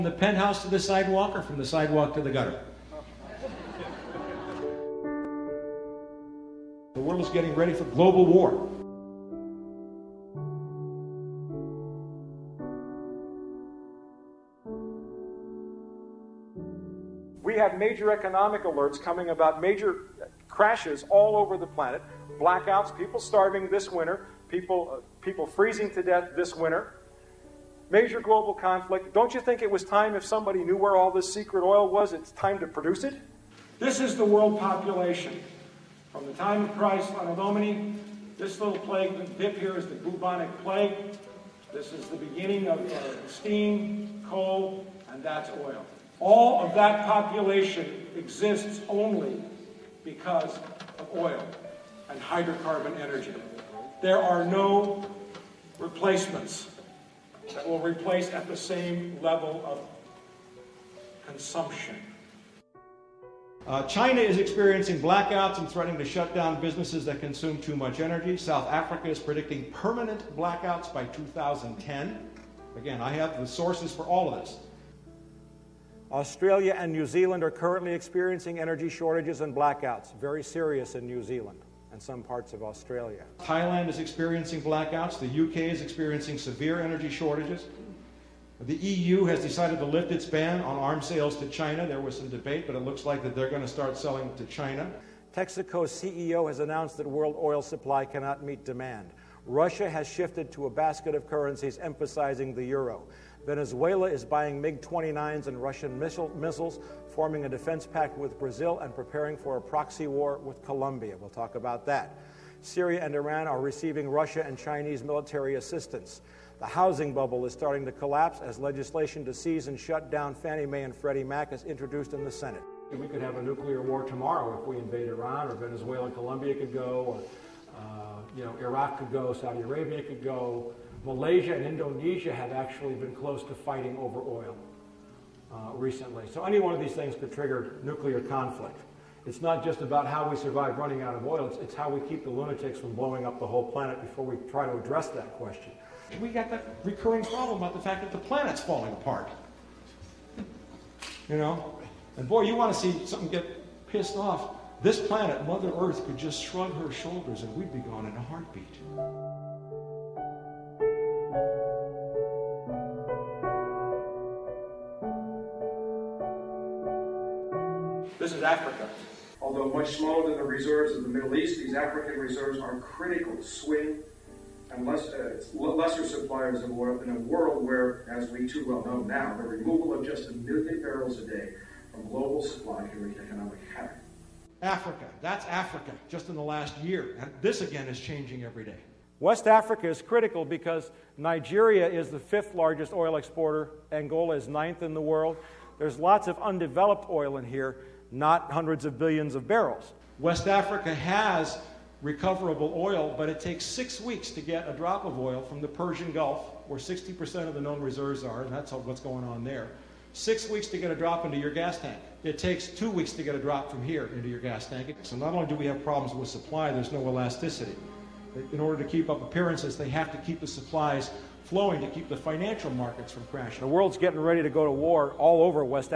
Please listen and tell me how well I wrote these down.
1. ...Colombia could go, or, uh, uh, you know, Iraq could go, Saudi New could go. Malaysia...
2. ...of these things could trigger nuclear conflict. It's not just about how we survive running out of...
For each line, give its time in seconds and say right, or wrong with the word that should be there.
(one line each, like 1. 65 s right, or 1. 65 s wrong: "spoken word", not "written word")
1. 126 s wrong: "Arabia", not "New"
2. 136 s right.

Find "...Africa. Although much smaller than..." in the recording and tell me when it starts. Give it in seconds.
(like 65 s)
168 s.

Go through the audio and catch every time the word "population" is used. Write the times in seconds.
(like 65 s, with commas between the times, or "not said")
34 s, 47 s.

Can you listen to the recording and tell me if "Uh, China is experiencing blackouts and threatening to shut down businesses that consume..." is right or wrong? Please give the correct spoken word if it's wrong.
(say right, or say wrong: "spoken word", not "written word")
right.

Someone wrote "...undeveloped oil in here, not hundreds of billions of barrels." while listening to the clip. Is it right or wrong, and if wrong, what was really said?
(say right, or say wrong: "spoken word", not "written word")
right.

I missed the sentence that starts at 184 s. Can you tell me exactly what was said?
Africa, that's Africa, just in the last year.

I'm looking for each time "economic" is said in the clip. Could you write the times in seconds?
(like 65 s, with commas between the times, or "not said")
18 s, 183 s.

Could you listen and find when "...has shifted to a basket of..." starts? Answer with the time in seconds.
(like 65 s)
99 s.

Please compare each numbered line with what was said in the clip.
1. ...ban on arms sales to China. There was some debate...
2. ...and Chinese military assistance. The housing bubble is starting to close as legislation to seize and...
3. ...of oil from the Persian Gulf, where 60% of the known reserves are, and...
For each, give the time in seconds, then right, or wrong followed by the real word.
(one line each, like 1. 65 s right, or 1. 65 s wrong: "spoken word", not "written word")
1. 90 s right
2. 114 s wrong: "collapse", not "close"
3. 205 s right.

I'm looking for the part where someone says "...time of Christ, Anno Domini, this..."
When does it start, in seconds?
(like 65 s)
36 s.